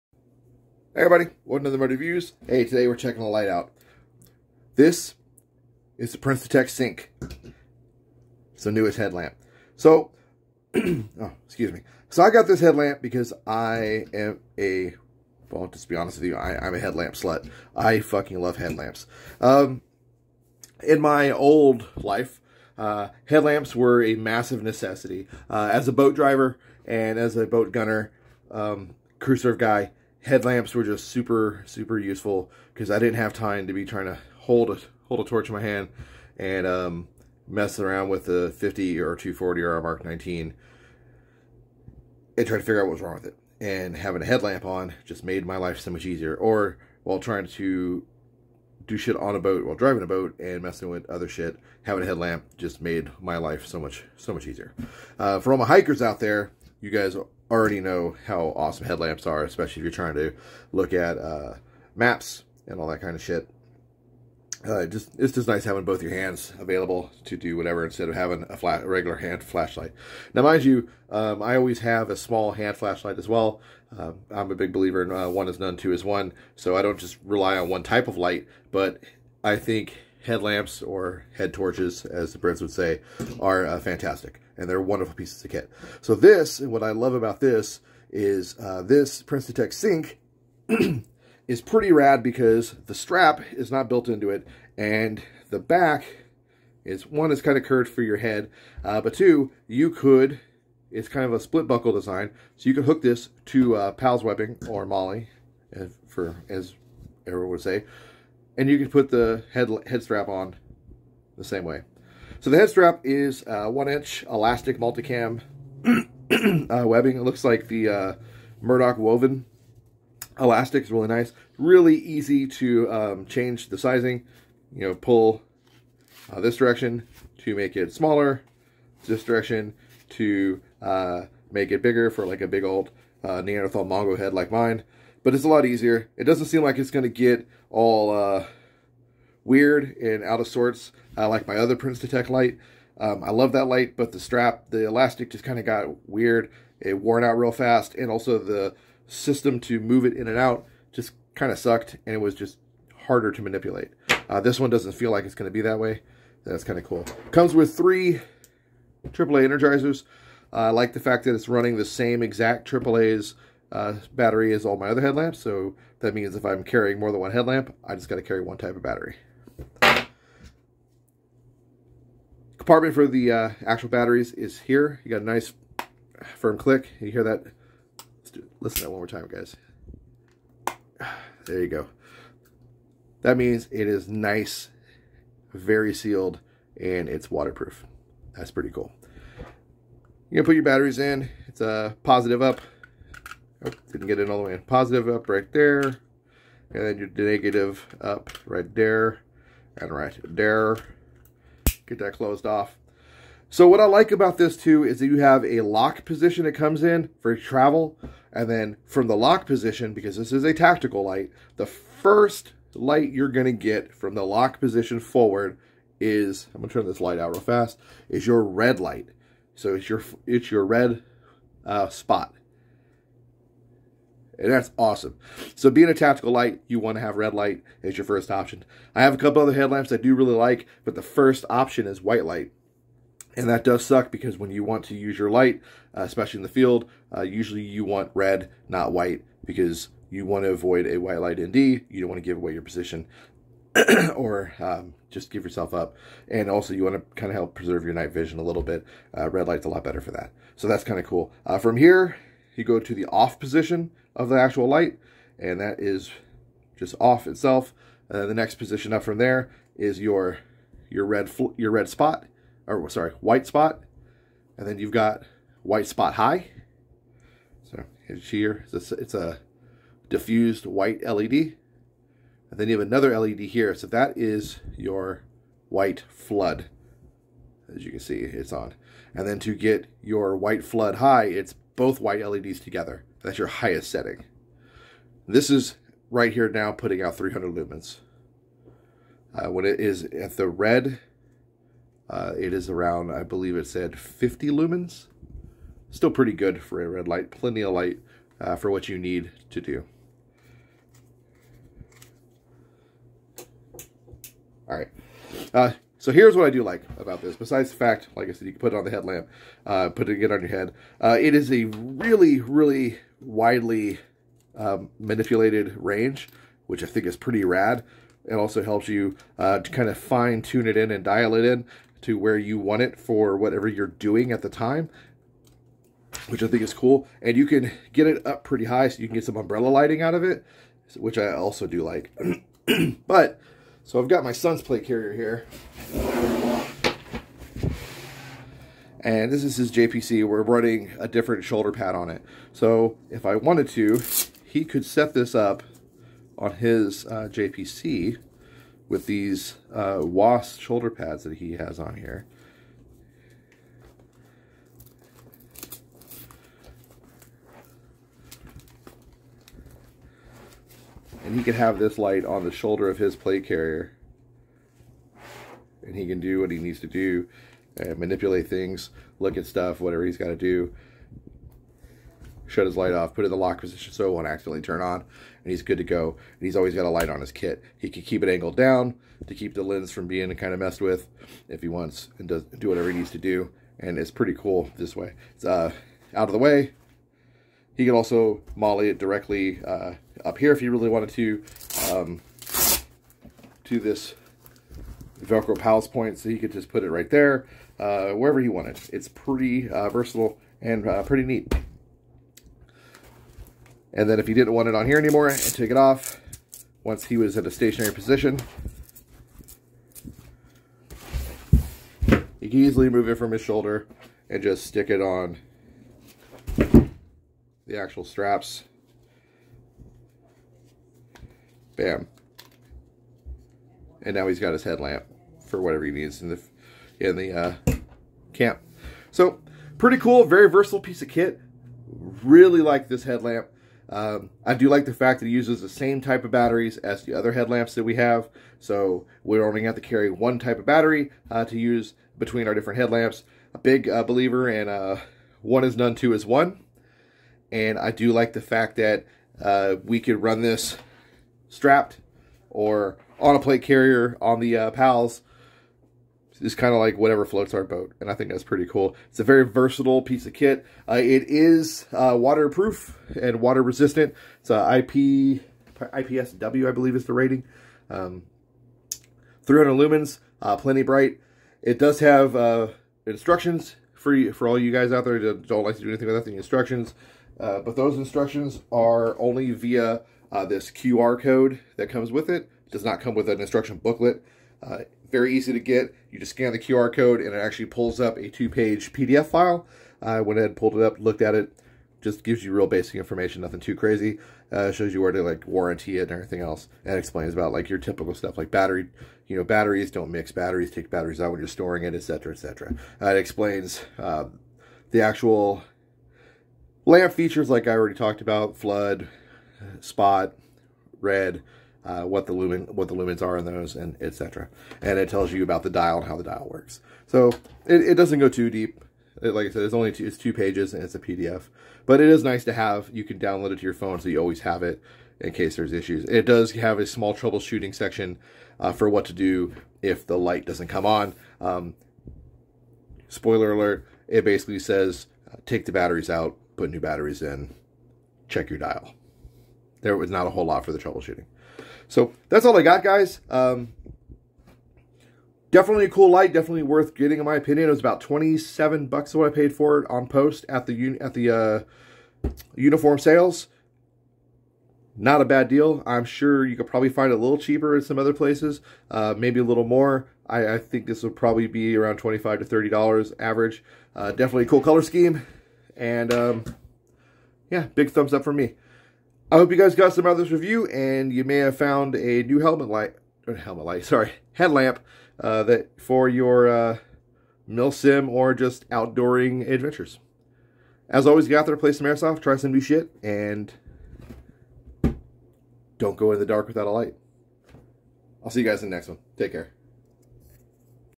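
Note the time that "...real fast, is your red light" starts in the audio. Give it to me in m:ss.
3:37.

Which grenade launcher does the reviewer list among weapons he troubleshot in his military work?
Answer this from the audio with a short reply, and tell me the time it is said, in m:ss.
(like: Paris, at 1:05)
Mark 19, at 0:39.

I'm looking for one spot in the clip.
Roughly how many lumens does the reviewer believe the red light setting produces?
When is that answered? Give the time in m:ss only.
4:53.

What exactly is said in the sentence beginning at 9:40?
As always, get out there, play some airsoft, try some new shit, and don't go in the dark without a light.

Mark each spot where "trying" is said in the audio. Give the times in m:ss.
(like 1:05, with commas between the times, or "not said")
0:33, 0:42, 0:47, 0:59.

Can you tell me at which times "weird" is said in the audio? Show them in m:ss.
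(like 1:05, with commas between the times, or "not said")
2:19, 2:26.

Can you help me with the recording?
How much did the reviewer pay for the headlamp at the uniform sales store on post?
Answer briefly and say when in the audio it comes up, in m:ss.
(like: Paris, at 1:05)
$27, at 9:08.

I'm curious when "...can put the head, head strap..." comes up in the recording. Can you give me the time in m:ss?
1:48.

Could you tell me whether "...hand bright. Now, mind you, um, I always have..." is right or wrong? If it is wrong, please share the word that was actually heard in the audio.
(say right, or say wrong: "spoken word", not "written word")
wrong: "flashlight", not "bright".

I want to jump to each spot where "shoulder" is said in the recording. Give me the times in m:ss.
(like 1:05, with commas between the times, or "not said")
5:41, 5:50, 6:02, 6:53.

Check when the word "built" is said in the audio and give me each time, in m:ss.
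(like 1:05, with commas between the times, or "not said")
1:33.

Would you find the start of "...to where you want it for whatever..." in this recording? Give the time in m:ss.
5:22.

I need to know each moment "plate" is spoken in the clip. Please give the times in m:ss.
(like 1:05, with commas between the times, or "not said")
5:34, 6:03, 7:33.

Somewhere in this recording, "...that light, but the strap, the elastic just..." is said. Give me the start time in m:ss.
2:23.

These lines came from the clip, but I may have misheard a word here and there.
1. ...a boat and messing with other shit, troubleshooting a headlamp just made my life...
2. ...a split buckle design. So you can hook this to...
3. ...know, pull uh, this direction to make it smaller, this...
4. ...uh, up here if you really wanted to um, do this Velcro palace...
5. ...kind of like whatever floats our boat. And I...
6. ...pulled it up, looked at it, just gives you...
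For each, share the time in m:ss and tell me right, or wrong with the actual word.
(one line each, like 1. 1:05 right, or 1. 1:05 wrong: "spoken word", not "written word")
1. 0:50 wrong: "having", not "troubleshooting"
2. 1:41 right
3. 2:04 right
4. 6:29 right
5. 7:36 right
6. 8:10 right.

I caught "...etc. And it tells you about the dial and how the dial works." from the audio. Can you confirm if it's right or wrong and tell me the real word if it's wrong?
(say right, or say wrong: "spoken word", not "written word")
right.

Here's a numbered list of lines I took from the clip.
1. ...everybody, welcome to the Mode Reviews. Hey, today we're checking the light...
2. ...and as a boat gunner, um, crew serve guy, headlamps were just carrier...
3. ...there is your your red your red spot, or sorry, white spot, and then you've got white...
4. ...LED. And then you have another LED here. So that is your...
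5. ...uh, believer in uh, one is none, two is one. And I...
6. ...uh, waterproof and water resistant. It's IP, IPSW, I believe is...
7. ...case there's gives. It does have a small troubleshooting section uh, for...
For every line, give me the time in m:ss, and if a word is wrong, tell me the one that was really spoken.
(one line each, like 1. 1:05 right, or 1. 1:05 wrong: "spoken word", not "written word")
1. 0:01 right
2. 0:26 wrong: "super", not "carrier"
3. 4:19 right
4. 4:31 right
5. 7:23 right
6. 7:41 right
7. 8:45 wrong: "issues", not "gives".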